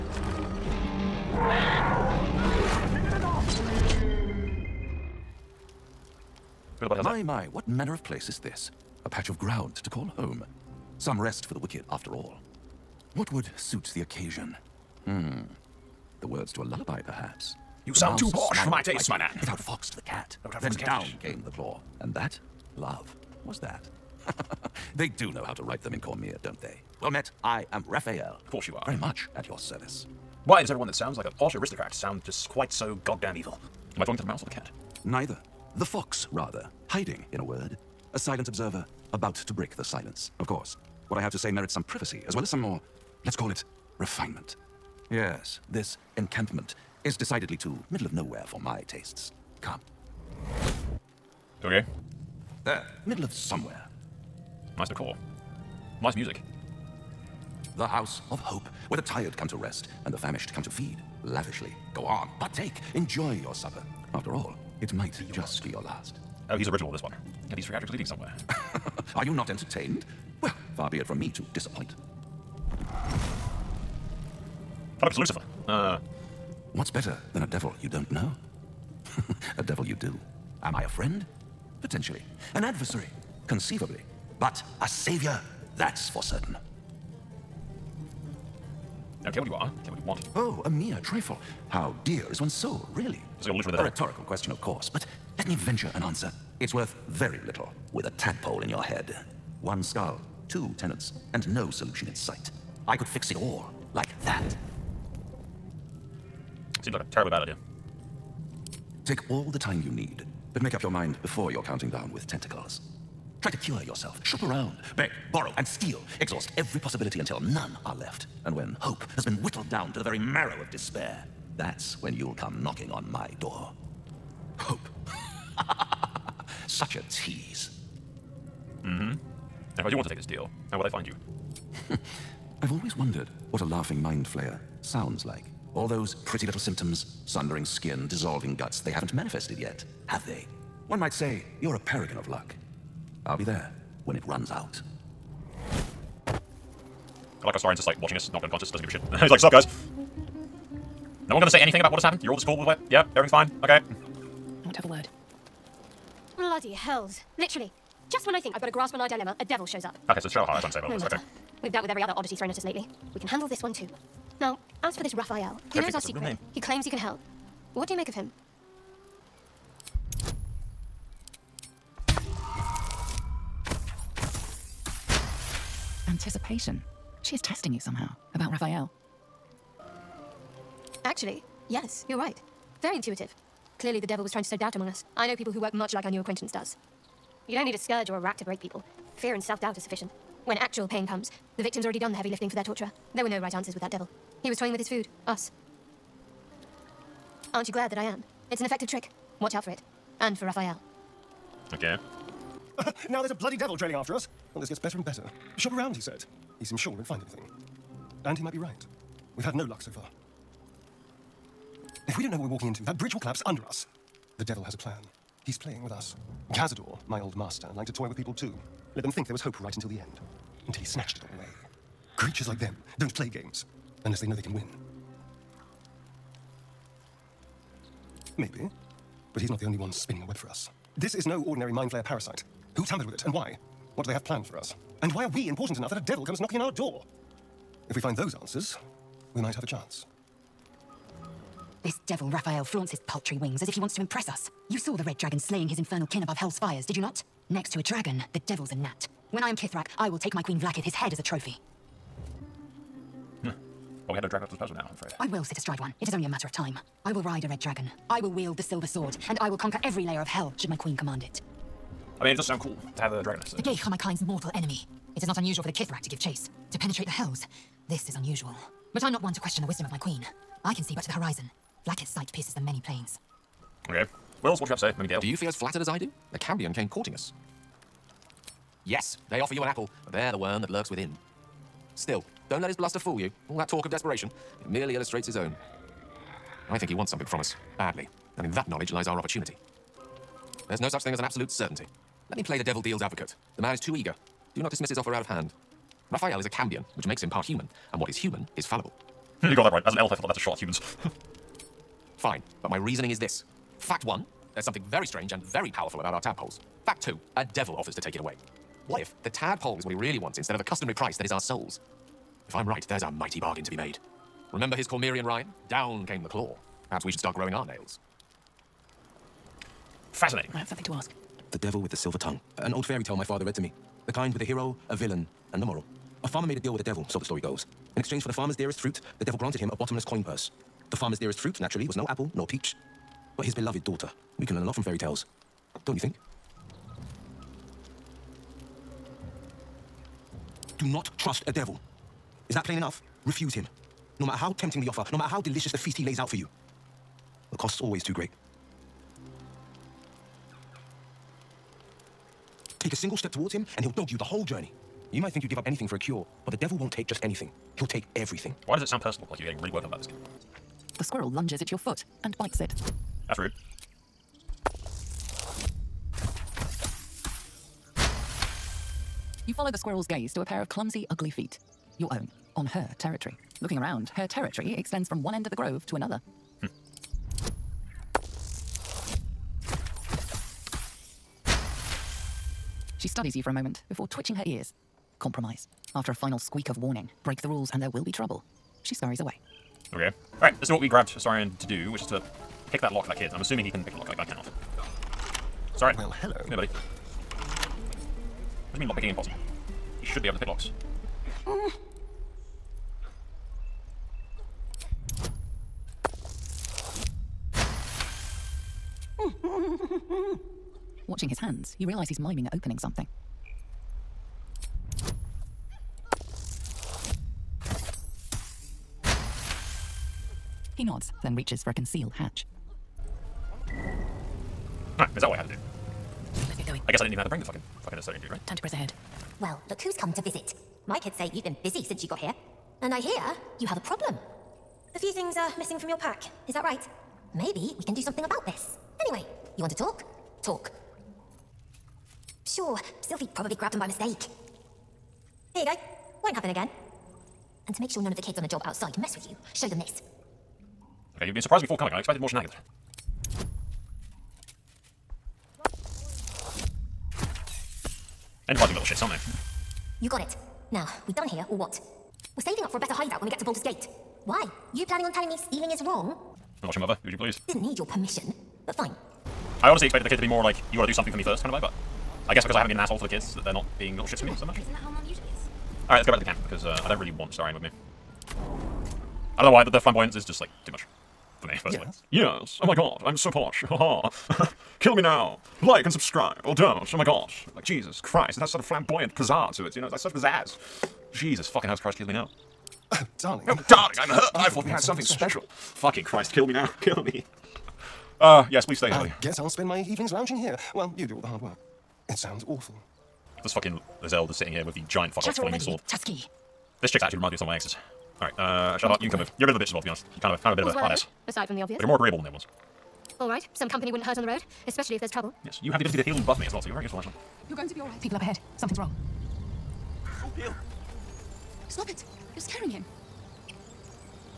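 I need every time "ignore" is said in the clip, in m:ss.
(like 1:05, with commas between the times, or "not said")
not said.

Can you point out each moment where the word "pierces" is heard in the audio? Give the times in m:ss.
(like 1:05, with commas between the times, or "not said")
4:32.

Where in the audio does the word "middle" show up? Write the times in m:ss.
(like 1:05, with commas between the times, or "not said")
0:47, 0:53.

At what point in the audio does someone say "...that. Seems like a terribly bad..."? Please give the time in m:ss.
1:44.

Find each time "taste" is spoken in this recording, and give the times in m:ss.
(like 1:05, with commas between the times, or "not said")
0:18, 0:48.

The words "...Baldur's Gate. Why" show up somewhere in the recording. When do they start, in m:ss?
7:43.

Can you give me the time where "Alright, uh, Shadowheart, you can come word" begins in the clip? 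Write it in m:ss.
8:28.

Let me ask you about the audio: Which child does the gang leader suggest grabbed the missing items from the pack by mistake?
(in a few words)
Sylphie.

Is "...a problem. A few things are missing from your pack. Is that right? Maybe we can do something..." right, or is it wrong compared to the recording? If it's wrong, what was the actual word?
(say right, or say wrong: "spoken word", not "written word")
right.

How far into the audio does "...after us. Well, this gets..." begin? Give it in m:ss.
3:23.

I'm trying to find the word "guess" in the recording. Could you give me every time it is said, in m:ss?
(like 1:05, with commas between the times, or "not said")
7:06, 7:52, 8:19.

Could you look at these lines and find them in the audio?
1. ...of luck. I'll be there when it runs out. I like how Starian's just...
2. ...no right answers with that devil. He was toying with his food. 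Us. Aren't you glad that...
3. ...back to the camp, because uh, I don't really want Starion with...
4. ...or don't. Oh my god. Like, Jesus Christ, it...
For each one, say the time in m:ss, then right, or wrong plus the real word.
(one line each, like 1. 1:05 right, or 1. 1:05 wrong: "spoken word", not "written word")
1. 2:22 right
2. 3:13 right
3. 7:56 right
4. 8:06 right.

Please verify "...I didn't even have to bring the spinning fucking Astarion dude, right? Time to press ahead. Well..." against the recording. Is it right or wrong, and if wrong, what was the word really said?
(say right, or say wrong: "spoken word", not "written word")
wrong: "fucking", not "spinning".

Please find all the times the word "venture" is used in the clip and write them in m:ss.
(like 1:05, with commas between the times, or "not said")
1:35.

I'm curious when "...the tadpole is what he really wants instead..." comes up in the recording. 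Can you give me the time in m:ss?
5:09.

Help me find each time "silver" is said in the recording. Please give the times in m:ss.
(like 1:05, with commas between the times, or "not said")
4:18, 5:21.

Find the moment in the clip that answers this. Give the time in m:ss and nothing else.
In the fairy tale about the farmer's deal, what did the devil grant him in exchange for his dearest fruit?
5:29.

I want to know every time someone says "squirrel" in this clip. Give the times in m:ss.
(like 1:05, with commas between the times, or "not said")
6:01, 6:09.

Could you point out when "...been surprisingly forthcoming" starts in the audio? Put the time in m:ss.
7:31.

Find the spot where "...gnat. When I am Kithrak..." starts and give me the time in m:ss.
4:08.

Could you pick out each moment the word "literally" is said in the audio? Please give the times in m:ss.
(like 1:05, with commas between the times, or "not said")
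1:33, 2:37.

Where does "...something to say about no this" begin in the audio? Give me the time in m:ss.
2:40.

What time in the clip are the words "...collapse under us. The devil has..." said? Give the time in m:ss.
3:33.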